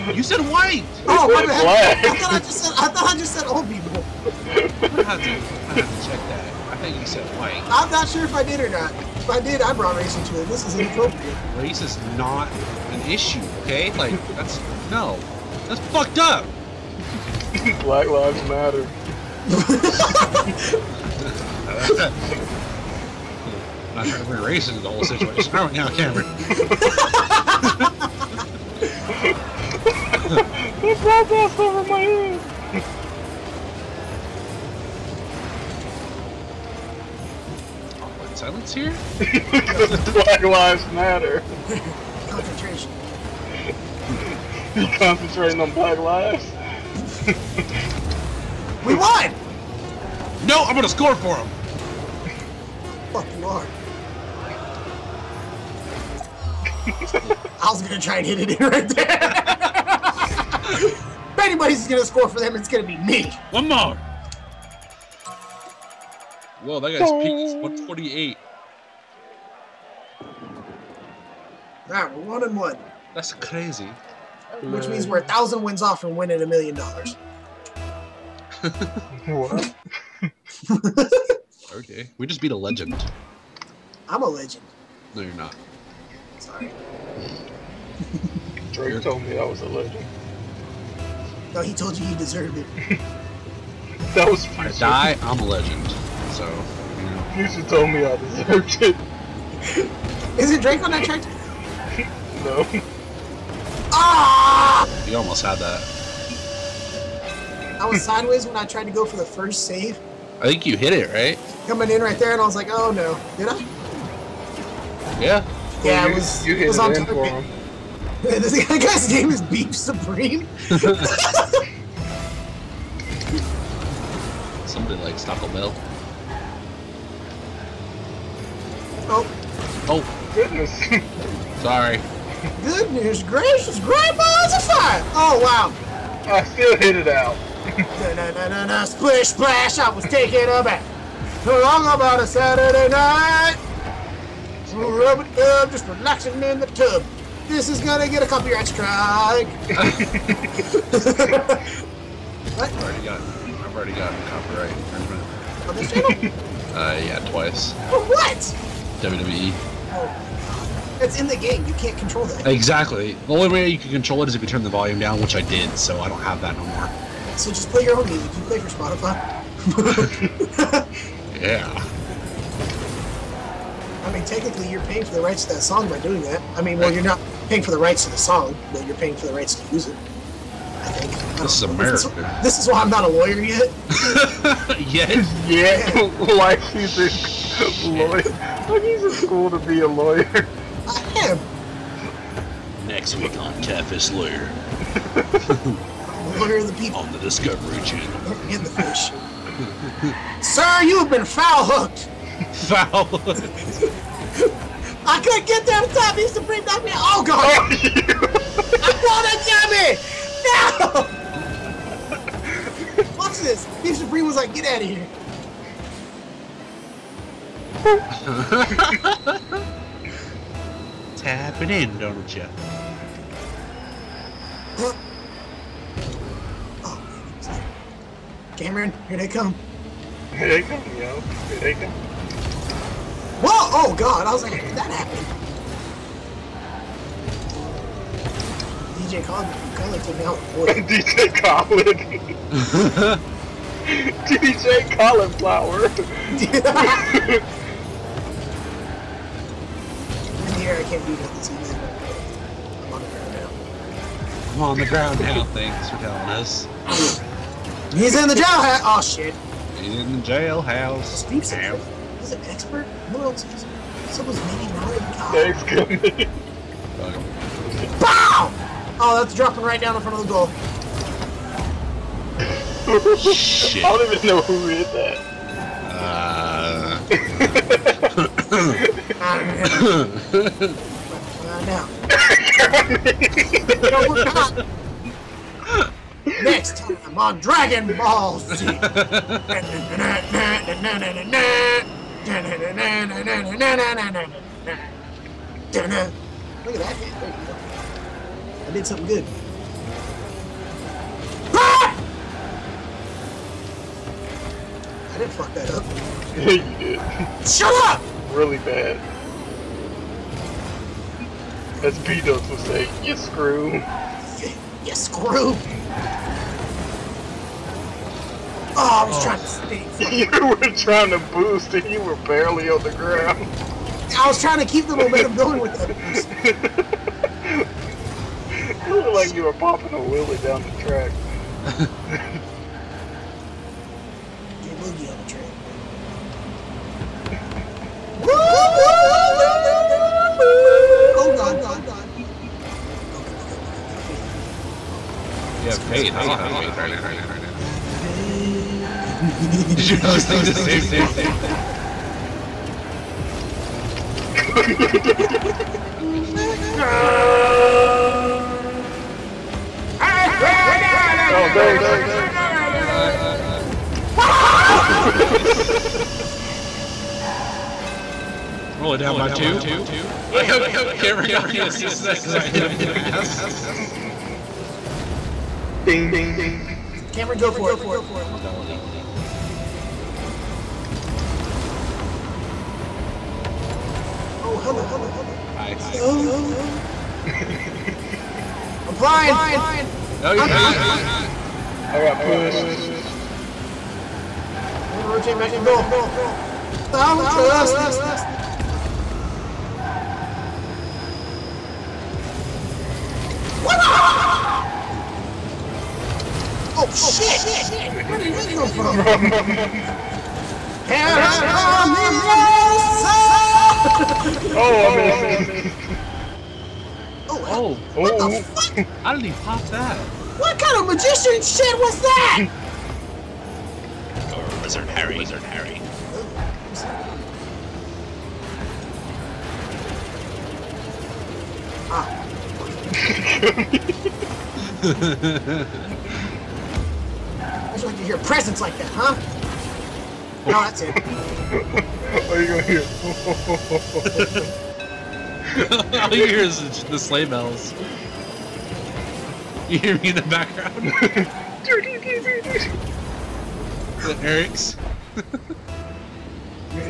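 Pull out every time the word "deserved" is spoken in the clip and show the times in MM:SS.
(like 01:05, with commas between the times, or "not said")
01:32, 01:38.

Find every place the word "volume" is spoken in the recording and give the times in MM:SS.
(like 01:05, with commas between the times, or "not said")
02:44.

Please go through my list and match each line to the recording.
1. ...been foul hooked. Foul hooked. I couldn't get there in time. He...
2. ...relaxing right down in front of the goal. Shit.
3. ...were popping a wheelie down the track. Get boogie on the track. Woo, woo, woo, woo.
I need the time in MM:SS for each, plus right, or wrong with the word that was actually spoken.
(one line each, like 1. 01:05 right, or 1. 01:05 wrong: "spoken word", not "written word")
1. 03:21 right
2. 04:29 wrong: "dropping", not "relaxing"
3. 05:29 right.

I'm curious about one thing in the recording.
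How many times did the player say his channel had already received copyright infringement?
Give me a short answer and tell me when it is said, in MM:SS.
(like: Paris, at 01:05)
2, at 02:37.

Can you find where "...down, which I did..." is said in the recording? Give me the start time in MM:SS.
02:44.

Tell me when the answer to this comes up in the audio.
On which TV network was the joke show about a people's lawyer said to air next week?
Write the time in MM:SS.
03:17.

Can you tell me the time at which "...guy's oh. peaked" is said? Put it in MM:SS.
01:06.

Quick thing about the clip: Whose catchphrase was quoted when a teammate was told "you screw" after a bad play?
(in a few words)
B-Dubs.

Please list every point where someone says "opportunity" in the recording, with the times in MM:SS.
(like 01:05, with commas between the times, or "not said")
not said.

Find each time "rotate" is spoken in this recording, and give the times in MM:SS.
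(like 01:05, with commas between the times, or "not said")
06:35.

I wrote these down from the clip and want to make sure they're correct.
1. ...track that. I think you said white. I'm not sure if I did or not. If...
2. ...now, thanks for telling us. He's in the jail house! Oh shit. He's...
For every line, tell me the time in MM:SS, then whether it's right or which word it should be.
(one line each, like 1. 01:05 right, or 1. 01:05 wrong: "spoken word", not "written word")
1. 00:06 wrong: "check", not "track"
2. 04:15 right.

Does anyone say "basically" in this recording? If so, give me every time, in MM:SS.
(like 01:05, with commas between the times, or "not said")
not said.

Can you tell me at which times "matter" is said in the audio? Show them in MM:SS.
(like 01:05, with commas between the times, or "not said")
00:18, 00:40.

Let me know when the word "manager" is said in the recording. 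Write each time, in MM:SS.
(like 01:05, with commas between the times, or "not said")
not said.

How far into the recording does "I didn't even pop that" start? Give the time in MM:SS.
06:59.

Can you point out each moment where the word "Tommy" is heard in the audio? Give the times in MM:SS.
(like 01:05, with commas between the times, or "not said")
03:30.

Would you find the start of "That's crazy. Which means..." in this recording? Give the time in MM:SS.
01:13.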